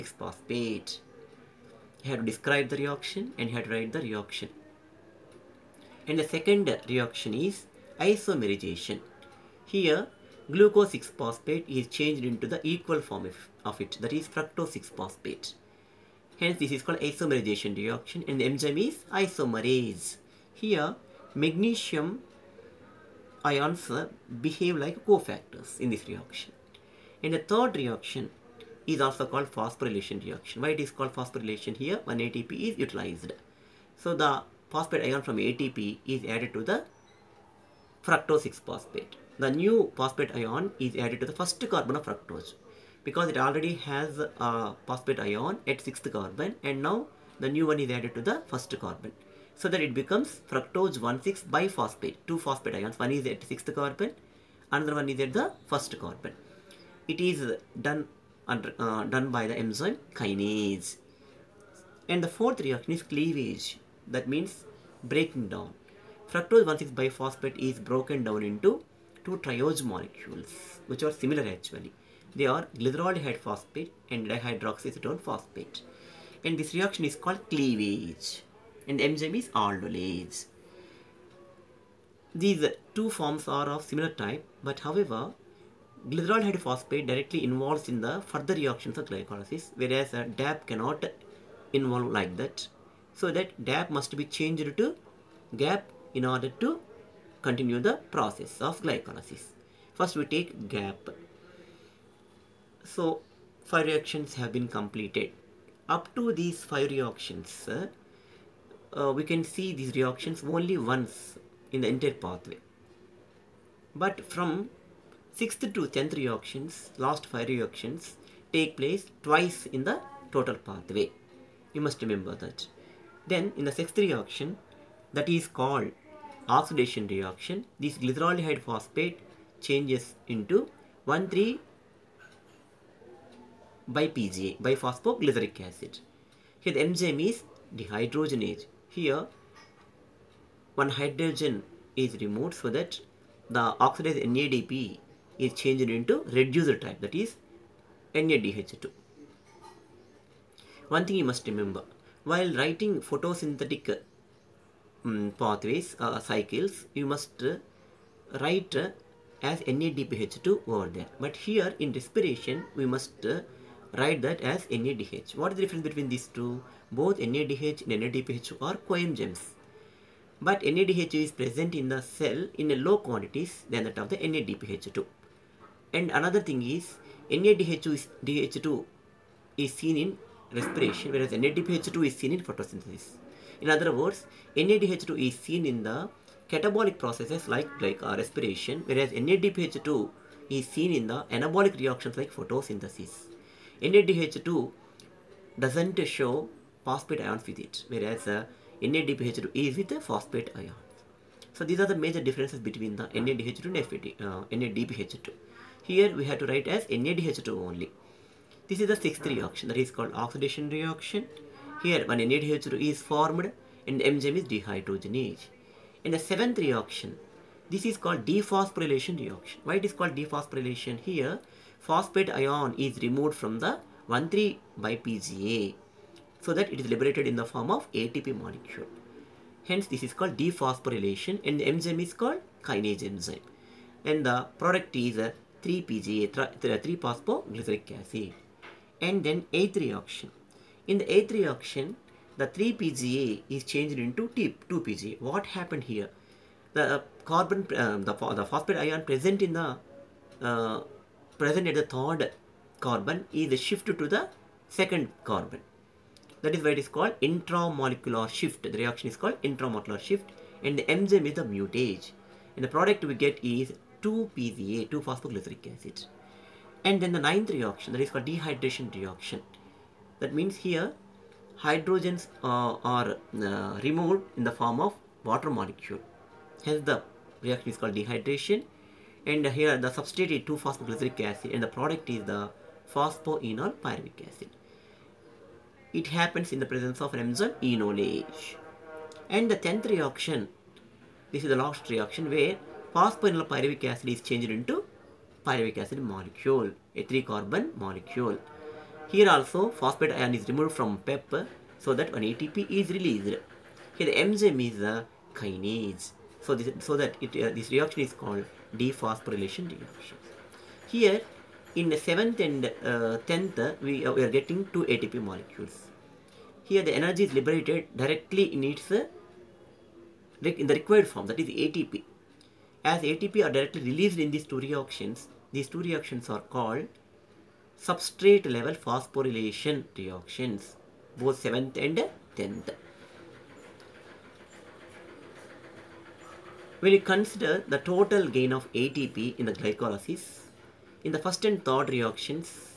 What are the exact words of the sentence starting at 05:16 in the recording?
Here the energy is liberated directly in its uh, in the required form that is ATP.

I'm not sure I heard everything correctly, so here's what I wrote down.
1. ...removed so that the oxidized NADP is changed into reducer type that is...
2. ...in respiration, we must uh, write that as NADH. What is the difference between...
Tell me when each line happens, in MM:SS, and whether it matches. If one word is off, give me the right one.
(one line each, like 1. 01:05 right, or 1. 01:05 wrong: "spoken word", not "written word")
1. 02:22 right
2. 02:41 right.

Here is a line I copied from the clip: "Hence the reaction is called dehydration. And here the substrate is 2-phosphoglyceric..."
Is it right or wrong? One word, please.
right.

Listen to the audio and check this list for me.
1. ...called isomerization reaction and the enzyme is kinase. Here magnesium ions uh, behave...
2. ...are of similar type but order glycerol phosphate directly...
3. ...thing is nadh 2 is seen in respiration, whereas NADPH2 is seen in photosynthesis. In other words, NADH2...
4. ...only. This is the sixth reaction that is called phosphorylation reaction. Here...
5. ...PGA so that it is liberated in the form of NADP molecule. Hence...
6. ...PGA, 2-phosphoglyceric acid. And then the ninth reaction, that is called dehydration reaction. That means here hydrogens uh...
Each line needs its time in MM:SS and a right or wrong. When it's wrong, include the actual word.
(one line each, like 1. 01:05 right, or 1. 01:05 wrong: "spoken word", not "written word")
1. 00:16 wrong: "isomerase", not "kinase"
2. 01:23 wrong: "however", not "order"
3. 02:56 right
4. 03:27 wrong: "oxidation", not "phosphorylation"
5. 03:44 wrong: "ATP", not "NADP"
6. 04:24 right.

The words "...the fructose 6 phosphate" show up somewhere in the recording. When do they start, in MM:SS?
00:36.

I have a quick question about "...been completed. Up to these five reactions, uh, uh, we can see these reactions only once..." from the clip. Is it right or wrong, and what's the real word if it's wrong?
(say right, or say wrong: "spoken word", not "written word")
right.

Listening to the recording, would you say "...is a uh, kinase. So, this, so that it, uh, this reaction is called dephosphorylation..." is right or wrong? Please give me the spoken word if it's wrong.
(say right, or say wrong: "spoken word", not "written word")
right.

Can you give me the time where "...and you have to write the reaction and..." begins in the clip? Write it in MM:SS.
00:03.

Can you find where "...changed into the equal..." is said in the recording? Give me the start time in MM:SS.
00:11.